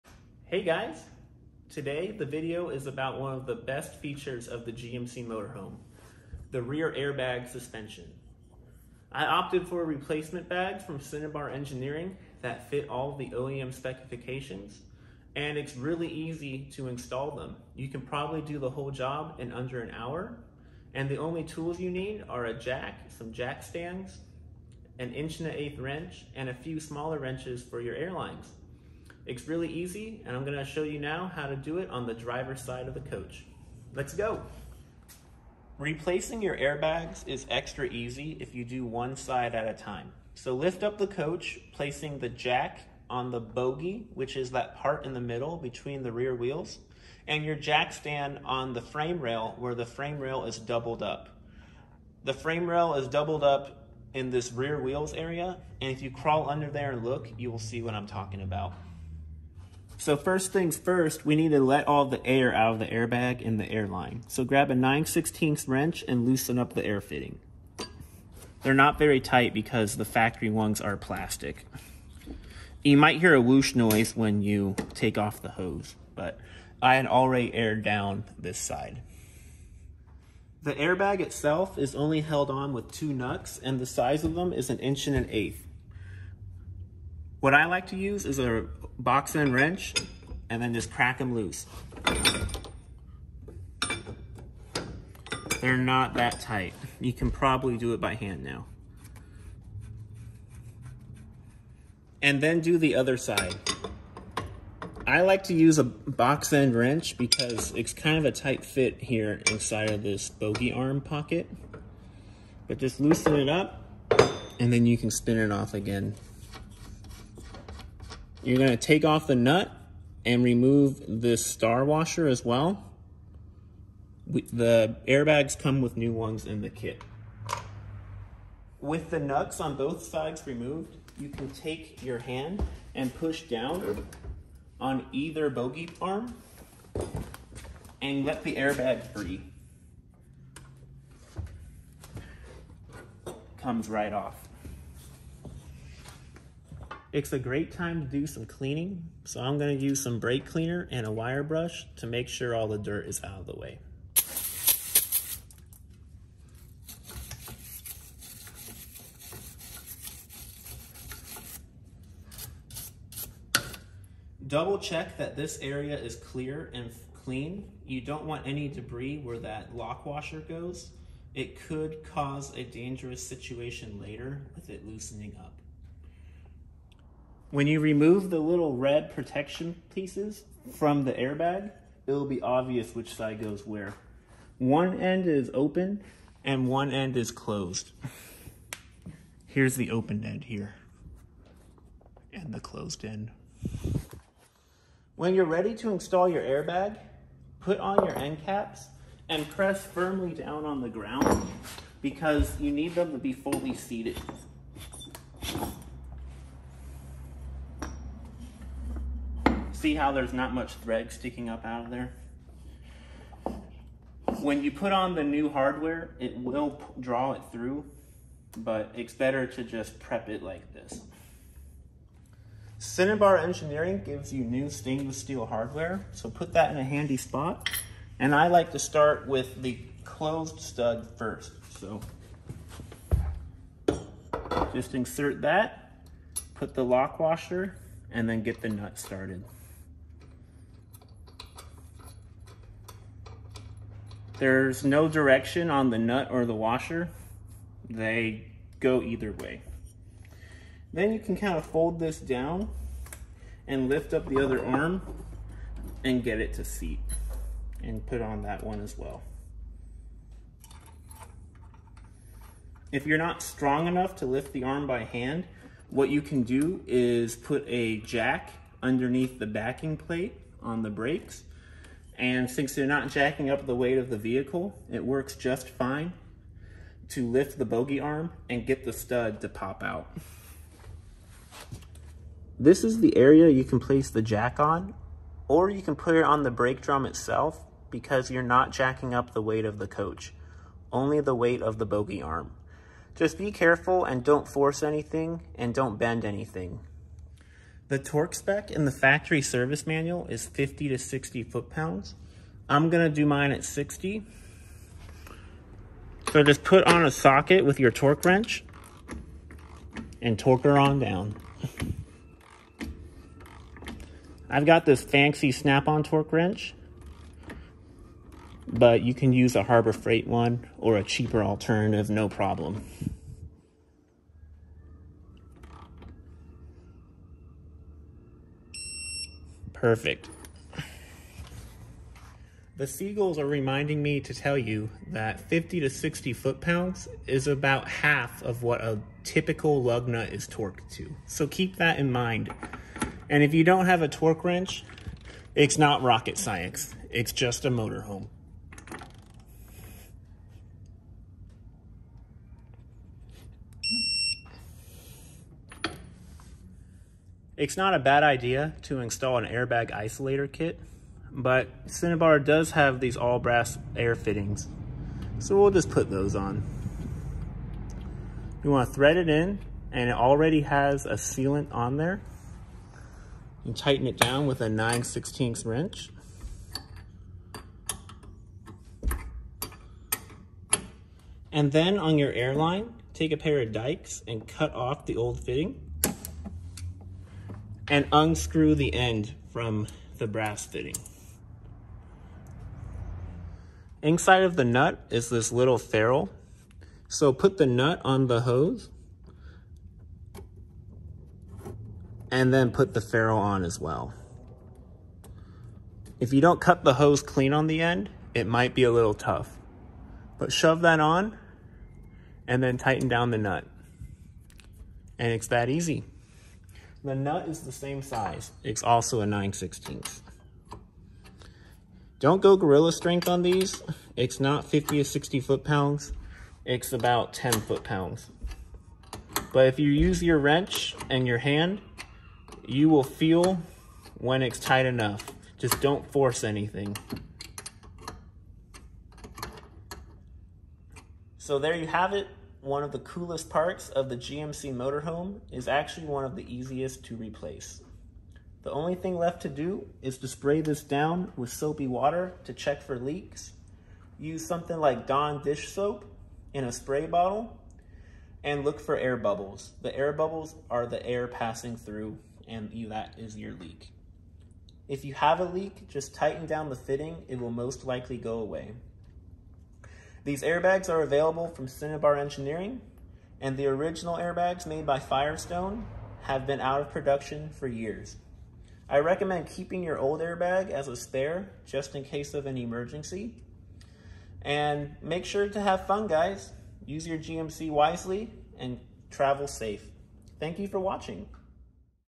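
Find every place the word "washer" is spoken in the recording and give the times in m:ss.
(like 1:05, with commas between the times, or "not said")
2:01, 2:50, 3:57, 4:06.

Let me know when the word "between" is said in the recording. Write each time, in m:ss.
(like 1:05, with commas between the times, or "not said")
0:45.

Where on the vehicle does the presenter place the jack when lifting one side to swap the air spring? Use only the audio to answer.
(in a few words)
the bogie.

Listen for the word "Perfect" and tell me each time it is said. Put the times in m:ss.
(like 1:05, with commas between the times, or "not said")
5:29.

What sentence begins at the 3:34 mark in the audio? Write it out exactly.
When you put on the new hardware, it will draw it through, but it's better to just prep it like this.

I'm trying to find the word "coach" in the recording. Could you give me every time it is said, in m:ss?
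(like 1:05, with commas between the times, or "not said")
0:33, 0:41, 4:49.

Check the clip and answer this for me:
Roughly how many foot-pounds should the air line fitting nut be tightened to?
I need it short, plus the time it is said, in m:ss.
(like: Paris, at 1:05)
10, at 7:07.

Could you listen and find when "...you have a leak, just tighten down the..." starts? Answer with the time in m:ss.
7:45.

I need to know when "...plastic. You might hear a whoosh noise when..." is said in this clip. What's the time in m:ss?
1:10.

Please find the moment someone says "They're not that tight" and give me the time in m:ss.
1:35.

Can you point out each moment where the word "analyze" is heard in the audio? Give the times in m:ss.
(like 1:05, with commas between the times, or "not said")
not said.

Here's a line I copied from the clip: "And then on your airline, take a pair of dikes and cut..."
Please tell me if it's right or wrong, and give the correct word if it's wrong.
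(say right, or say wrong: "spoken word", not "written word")
right.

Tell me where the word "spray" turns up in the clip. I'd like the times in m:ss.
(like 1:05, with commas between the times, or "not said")
7:30, 7:36.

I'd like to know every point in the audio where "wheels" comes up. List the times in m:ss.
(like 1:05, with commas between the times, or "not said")
0:46, 0:54.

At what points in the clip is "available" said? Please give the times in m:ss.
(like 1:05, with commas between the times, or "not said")
7:51.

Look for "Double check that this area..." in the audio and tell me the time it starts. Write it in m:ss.
2:44.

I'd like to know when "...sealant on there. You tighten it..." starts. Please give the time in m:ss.
6:11.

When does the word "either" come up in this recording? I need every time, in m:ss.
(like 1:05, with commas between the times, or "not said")
2:15, 4:09.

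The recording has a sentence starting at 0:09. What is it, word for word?
I opted for replacement bags from Cinnabar Engineering that fit all the OEM specifications, and it's really easy to install them.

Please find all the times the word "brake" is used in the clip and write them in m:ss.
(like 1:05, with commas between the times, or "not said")
2:30, 4:30, 4:46.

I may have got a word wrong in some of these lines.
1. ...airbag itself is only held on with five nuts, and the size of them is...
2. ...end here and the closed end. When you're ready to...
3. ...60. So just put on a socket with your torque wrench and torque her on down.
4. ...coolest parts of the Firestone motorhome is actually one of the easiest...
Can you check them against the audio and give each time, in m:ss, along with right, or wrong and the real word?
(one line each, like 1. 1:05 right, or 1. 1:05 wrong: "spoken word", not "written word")
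1. 1:20 wrong: "two", not "five"
2. 3:10 right
3. 5:03 right
4. 7:22 wrong: "GMC", not "Firestone".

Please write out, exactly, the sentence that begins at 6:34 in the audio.
Inside of the nut is this little ferrule.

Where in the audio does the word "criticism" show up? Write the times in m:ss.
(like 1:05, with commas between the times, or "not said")
not said.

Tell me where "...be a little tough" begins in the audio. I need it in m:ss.
6:48.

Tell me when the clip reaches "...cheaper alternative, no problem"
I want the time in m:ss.
5:21.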